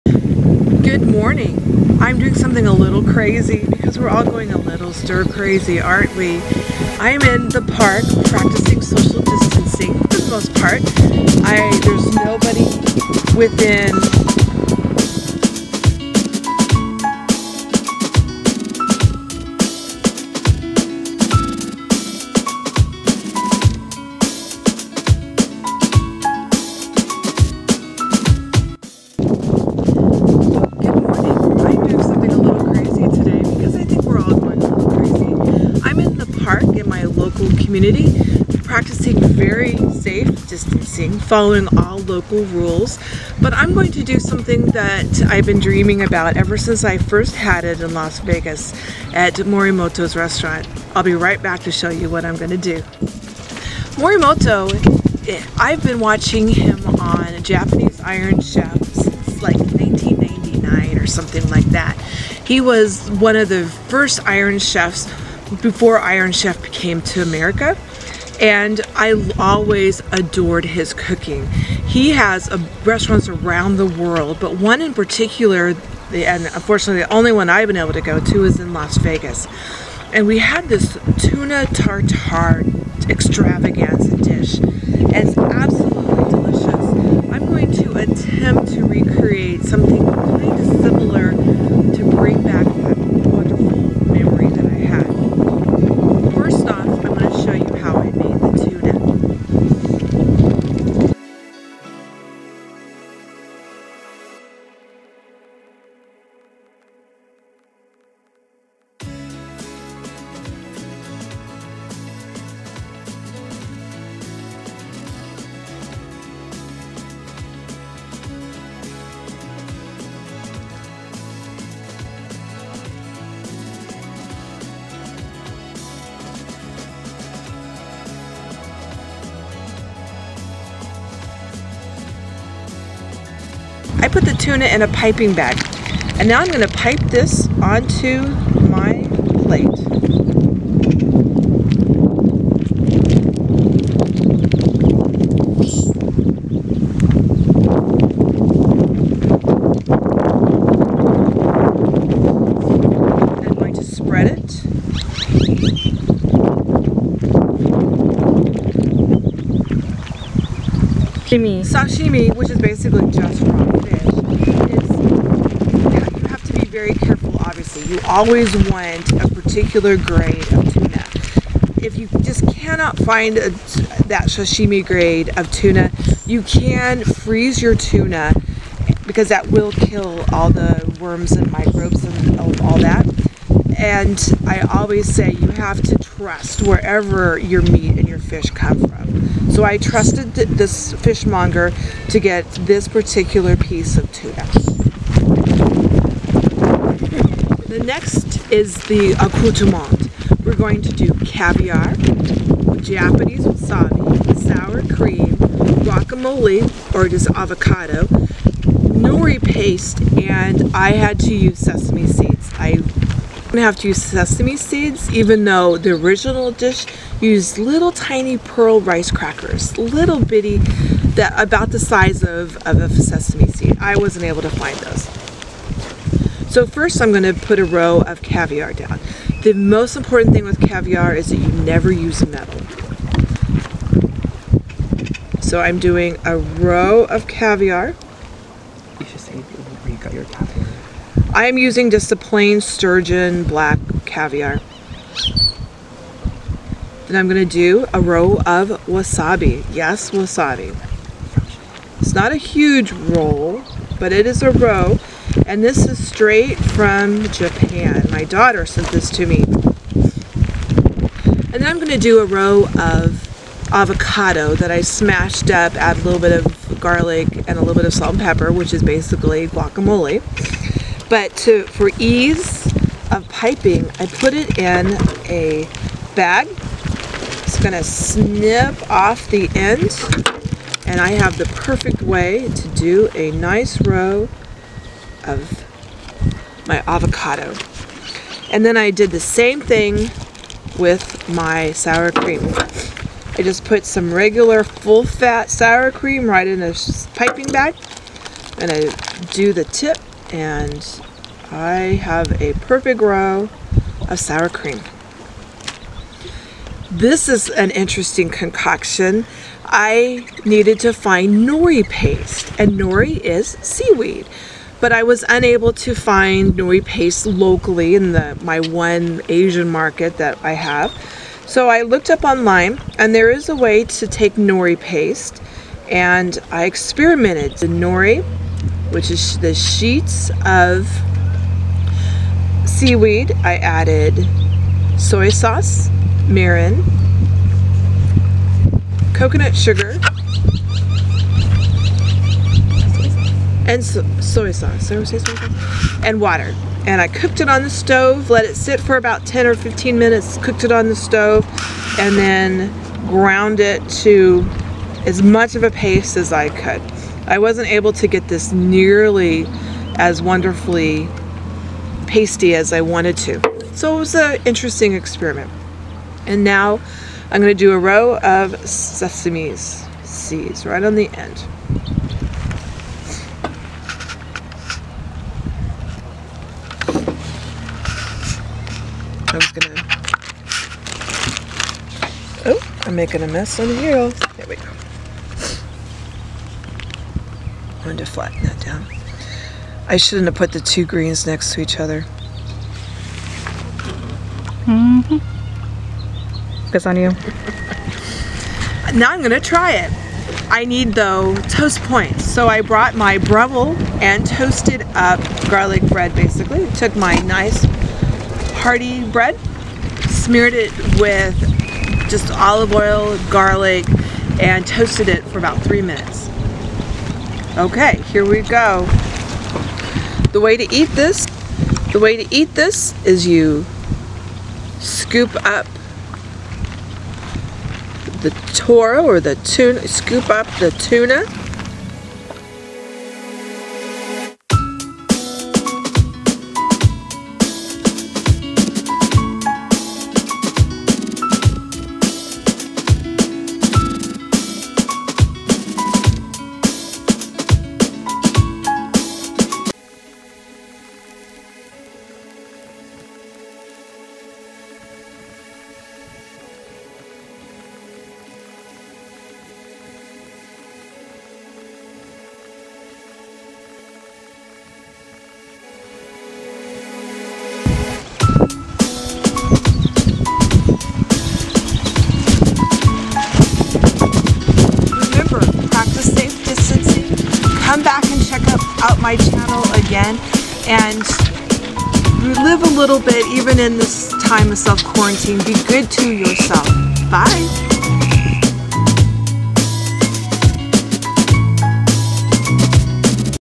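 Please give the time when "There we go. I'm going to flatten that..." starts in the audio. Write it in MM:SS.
06:24.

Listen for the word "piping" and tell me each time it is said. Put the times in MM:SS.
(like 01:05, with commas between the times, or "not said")
02:14, 04:33, 04:57.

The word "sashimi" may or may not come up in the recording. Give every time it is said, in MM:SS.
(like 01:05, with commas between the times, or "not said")
02:41, 02:54.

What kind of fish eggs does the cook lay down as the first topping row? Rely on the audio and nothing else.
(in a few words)
Sturgeon black caviar.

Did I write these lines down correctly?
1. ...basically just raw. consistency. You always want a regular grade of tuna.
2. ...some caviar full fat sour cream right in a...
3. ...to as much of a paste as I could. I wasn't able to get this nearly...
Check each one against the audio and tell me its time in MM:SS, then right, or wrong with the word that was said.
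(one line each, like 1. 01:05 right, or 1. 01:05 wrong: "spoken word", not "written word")
1. 02:42 wrong: "particular", not "regular"
2. 04:53 wrong: "regular", not "caviar"
3. 05:54 right.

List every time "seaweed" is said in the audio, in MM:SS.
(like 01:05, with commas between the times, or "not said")
05:13, 05:32.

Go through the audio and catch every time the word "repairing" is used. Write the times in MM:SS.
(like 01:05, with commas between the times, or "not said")
not said.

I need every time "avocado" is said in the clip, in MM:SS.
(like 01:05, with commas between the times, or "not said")
03:27, 04:23, 04:46.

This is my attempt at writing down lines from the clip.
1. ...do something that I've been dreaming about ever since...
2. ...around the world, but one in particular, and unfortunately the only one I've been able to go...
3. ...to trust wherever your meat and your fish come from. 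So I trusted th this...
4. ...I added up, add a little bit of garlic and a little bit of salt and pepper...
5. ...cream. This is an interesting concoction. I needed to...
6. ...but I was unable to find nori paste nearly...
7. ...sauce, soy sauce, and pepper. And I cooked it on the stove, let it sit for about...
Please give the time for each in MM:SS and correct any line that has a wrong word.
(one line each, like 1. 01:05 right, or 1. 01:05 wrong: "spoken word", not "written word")
1. 00:44 right
2. 01:13 right
3. 03:05 right
4. 04:24 wrong: "smashed", not "added"
5. 05:04 right
6. 05:14 wrong: "locally", not "nearly"
7. 05:44 wrong: "water", not "pepper".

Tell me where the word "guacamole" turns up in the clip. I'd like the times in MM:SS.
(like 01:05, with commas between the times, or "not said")
03:25, 04:29.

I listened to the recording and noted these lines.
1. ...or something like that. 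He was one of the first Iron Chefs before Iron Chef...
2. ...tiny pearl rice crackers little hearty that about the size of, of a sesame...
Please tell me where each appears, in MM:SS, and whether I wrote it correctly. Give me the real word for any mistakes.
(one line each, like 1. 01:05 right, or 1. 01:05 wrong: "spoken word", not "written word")
1. 01:00 right
2. 03:37 wrong: "bitty", not "hearty".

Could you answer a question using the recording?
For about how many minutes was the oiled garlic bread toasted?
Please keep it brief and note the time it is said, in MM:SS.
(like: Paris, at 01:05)
3 minutes, at 06:55.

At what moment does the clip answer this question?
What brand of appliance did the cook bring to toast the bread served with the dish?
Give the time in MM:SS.
06:43.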